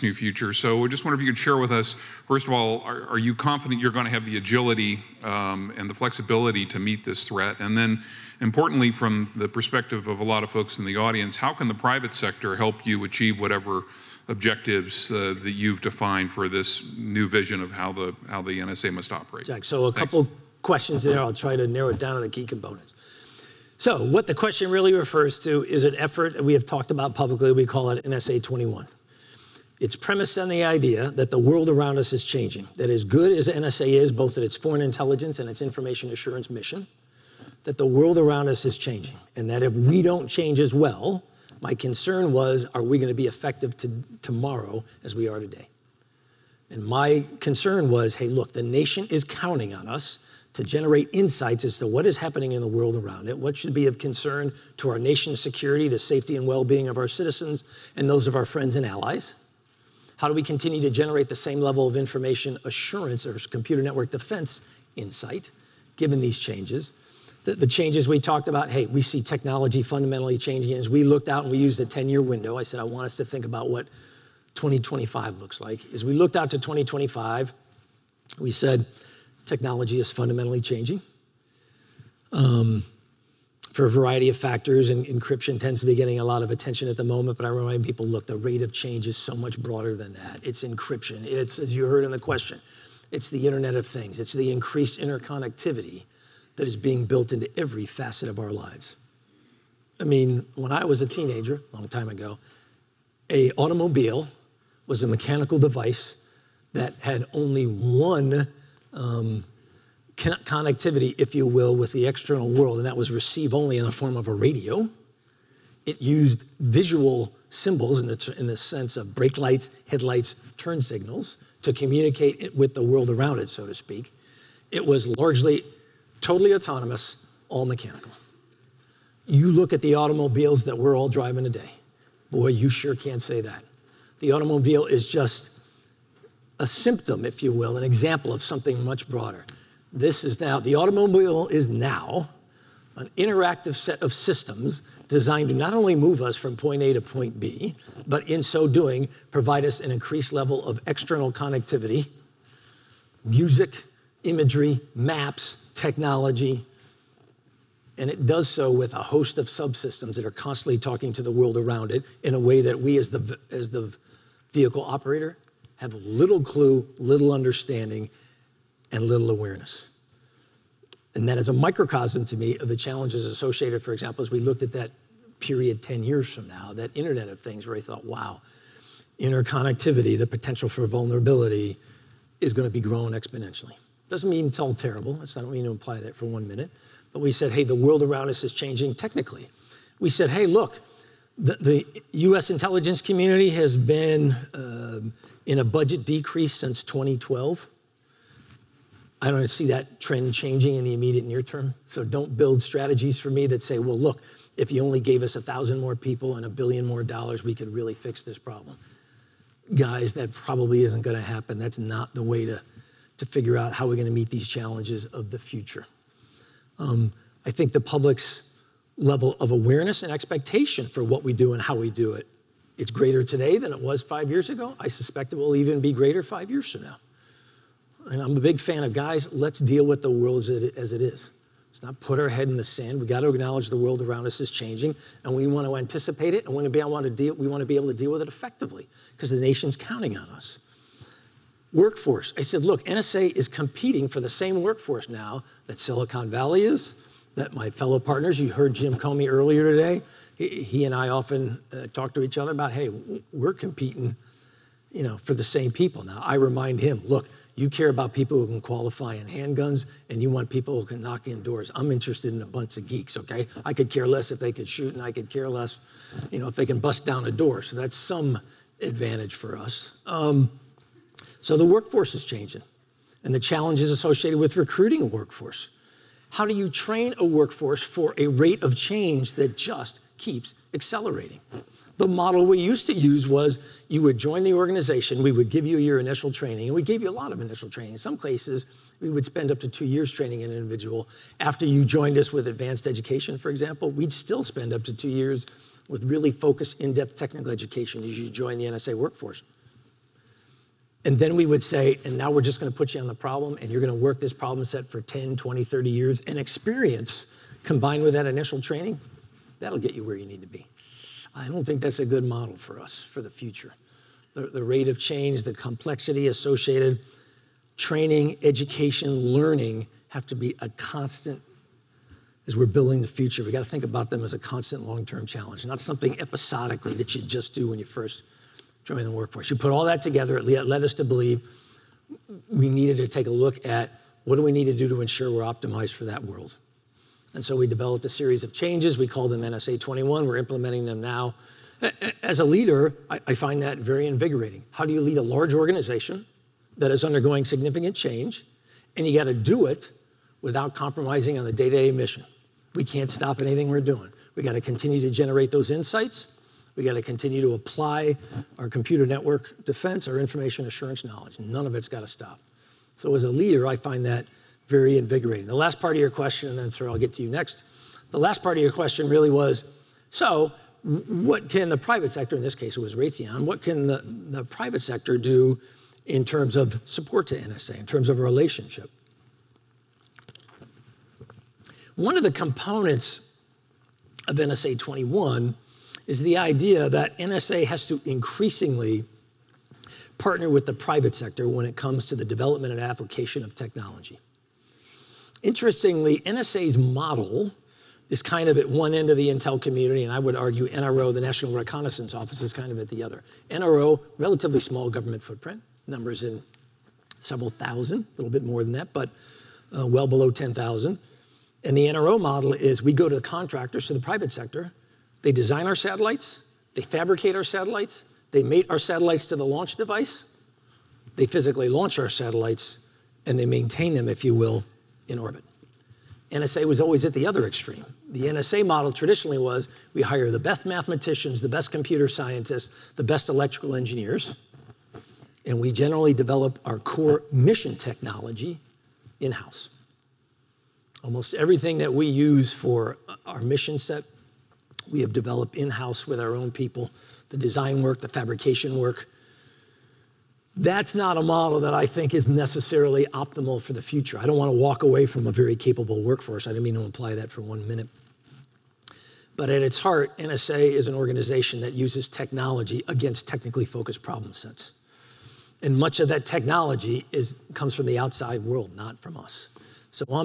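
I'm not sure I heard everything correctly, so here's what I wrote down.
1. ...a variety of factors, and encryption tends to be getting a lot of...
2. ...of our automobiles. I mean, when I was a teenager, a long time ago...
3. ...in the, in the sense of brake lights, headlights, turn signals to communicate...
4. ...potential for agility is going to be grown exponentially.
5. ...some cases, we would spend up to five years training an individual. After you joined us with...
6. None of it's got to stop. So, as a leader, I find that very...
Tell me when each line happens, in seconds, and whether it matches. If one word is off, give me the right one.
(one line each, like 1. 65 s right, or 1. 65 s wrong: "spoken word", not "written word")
1. 83 s right
2. 98 s wrong: "lives", not "automobiles"
3. 118 s right
4. 180 s wrong: "vulnerability", not "agility"
5. 287 s wrong: "two", not "five"
6. 361 s right.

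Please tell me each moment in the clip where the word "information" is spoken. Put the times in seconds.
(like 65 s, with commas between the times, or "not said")
35 s, 61 s, 360 s.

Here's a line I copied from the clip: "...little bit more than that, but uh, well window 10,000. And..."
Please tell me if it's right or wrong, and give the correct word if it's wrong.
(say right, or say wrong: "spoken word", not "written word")
wrong: "below", not "window".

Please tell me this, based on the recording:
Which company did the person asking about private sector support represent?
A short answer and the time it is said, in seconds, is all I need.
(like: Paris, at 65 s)
Raytheon, at 372 s.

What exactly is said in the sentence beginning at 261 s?
I'm interested in a bunch of geeks, okay?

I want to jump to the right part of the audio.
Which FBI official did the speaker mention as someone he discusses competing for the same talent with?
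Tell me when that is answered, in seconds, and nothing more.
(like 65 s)
248 s.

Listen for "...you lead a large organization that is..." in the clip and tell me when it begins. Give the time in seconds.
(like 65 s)
344 s.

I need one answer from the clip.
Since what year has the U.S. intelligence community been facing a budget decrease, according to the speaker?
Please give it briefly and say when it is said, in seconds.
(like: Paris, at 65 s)
2012, at 196 s.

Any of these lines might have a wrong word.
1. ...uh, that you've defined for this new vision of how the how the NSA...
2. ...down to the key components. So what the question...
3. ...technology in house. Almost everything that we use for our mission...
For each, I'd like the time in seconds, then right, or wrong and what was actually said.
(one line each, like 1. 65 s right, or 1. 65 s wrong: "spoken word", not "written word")
1. 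15 s right
2. 21 s right
3. 437 s right.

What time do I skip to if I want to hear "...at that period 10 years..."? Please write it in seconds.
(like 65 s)
174 s.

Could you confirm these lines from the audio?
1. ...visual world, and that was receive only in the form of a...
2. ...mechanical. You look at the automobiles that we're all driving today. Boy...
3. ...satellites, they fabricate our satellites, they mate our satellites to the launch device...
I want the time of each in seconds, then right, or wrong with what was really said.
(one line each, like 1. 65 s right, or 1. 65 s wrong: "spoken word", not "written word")
1. 112 s wrong: "external", not "visual"
2. 127 s right
3. 415 s right.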